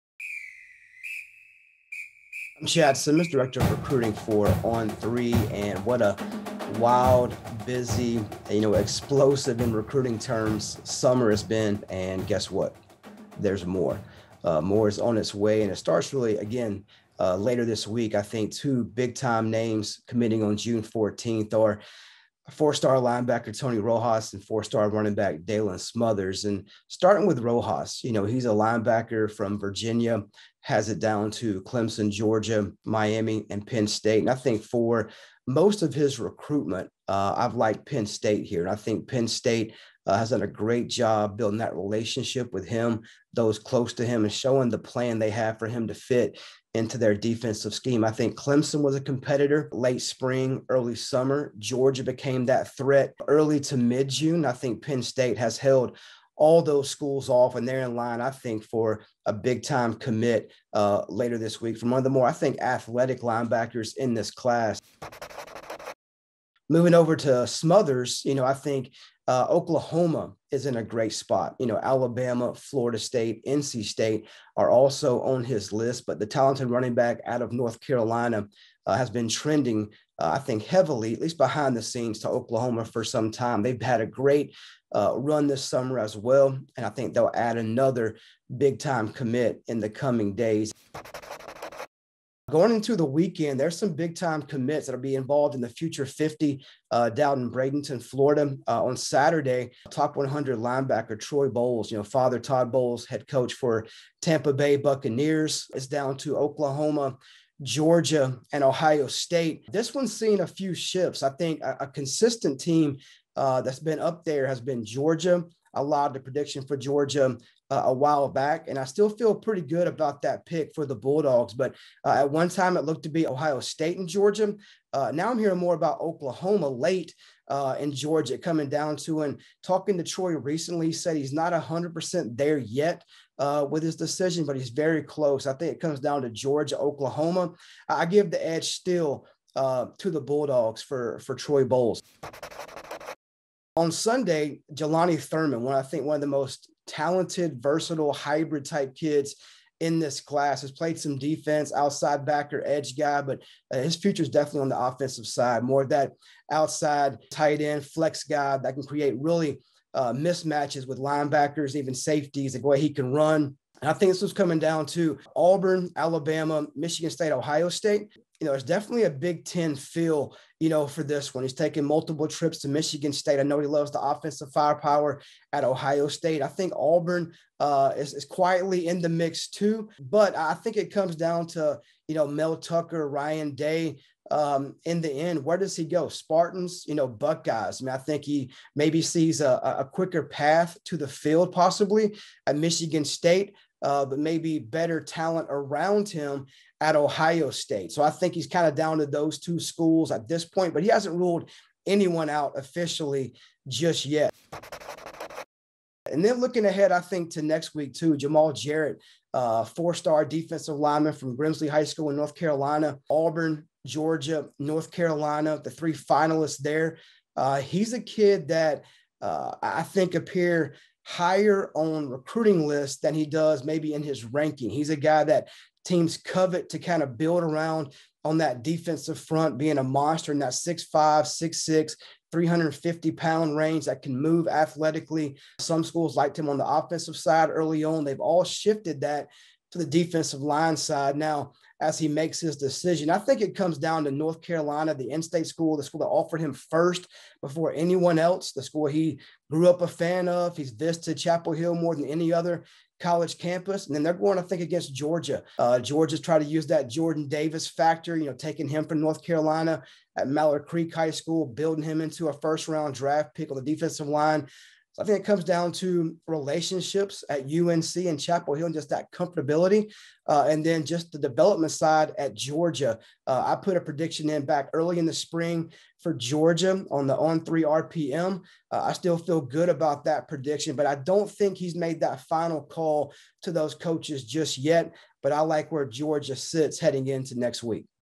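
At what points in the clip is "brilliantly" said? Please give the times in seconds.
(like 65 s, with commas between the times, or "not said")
not said.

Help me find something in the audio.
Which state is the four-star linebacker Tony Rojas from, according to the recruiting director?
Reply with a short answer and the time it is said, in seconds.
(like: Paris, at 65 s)
Virginia, at 29 s.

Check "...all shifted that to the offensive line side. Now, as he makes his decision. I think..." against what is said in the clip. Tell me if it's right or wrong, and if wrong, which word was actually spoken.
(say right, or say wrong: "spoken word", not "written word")
wrong: "defensive", not "offensive".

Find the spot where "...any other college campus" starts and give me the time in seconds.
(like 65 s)
252 s.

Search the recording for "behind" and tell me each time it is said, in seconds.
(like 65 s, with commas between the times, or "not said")
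81 s.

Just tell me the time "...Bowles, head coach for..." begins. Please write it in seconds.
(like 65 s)
102 s.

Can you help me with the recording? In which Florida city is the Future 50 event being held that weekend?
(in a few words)
Bradenton, Florida.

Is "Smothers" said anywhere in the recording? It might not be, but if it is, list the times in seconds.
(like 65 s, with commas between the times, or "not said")
25 s, 67 s.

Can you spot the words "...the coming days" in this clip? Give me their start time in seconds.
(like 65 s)
89 s.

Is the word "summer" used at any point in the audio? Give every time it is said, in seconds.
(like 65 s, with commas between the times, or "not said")
10 s, 50 s, 85 s.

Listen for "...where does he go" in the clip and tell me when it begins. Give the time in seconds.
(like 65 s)
185 s.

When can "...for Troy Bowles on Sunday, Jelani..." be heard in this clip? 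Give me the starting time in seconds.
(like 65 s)
141 s.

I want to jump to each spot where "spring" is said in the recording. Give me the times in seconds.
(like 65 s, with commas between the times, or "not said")
50 s, 275 s.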